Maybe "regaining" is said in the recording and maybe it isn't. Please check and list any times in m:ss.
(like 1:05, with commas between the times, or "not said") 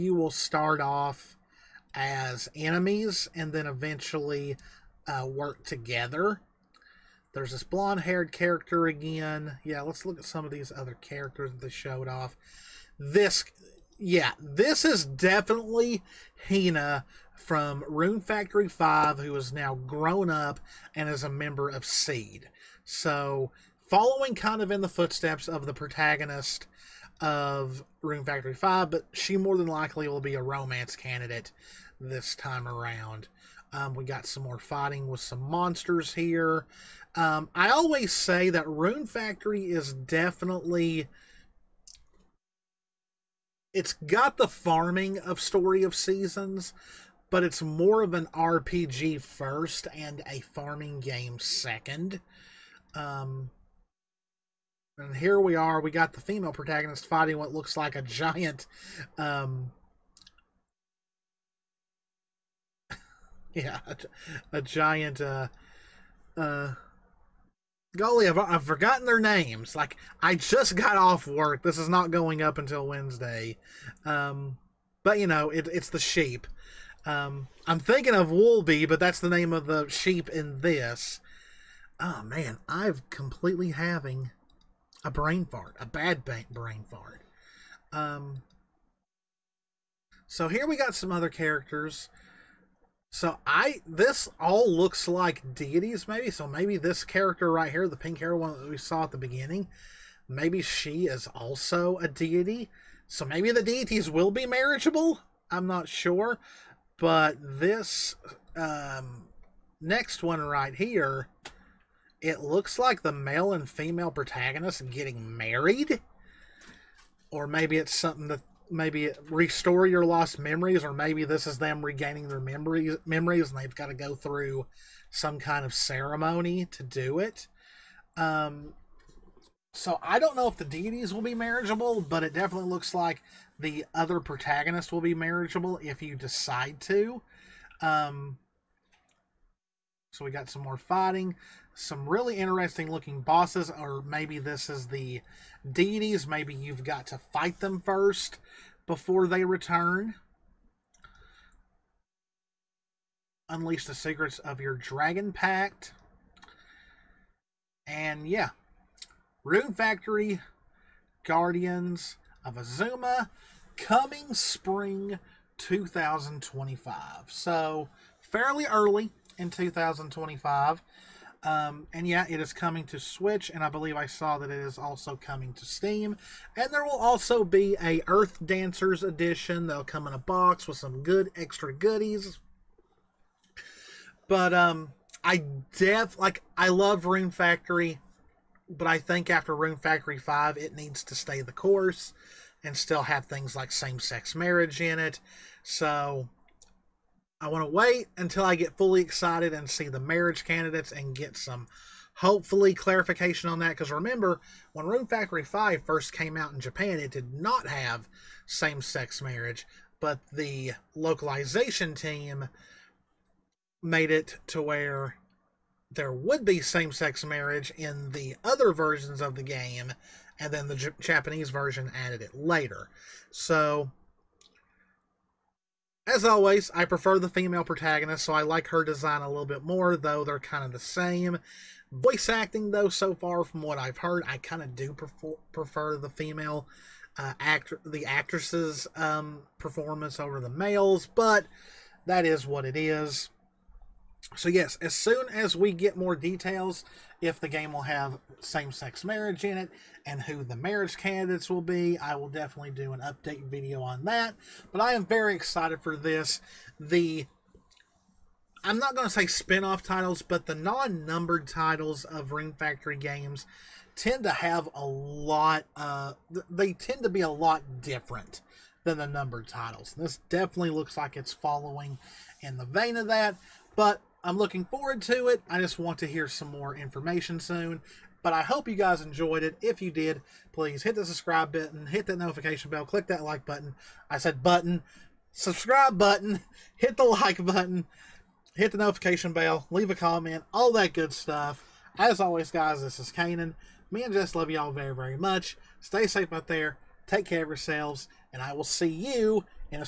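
2:01.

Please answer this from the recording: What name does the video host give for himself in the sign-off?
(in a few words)
Cannan.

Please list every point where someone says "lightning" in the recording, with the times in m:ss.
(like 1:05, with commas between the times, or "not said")
not said.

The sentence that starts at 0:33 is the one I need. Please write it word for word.
Um, we got some more fighting with some monsters here.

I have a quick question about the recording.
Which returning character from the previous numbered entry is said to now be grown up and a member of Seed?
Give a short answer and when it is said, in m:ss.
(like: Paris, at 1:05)
Hina, at 0:16.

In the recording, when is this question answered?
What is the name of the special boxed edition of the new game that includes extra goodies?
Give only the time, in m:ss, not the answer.
2:58.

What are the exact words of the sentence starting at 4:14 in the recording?
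But I am very excited for this.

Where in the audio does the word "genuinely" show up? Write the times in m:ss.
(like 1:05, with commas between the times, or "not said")
not said.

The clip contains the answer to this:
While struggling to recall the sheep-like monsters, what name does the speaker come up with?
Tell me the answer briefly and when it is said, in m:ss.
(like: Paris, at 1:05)
Woolby, at 1:18.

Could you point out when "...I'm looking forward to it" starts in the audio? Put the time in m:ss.
4:34.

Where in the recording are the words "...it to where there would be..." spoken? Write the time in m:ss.
3:34.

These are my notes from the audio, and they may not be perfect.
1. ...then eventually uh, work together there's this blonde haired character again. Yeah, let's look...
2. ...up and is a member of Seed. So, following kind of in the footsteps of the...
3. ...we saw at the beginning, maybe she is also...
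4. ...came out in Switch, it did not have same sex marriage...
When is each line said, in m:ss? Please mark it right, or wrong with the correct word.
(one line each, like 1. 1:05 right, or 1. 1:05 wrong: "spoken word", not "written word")
1. 0:03 right
2. 0:20 right
3. 1:38 right
4. 3:26 wrong: "Japan", not "Switch".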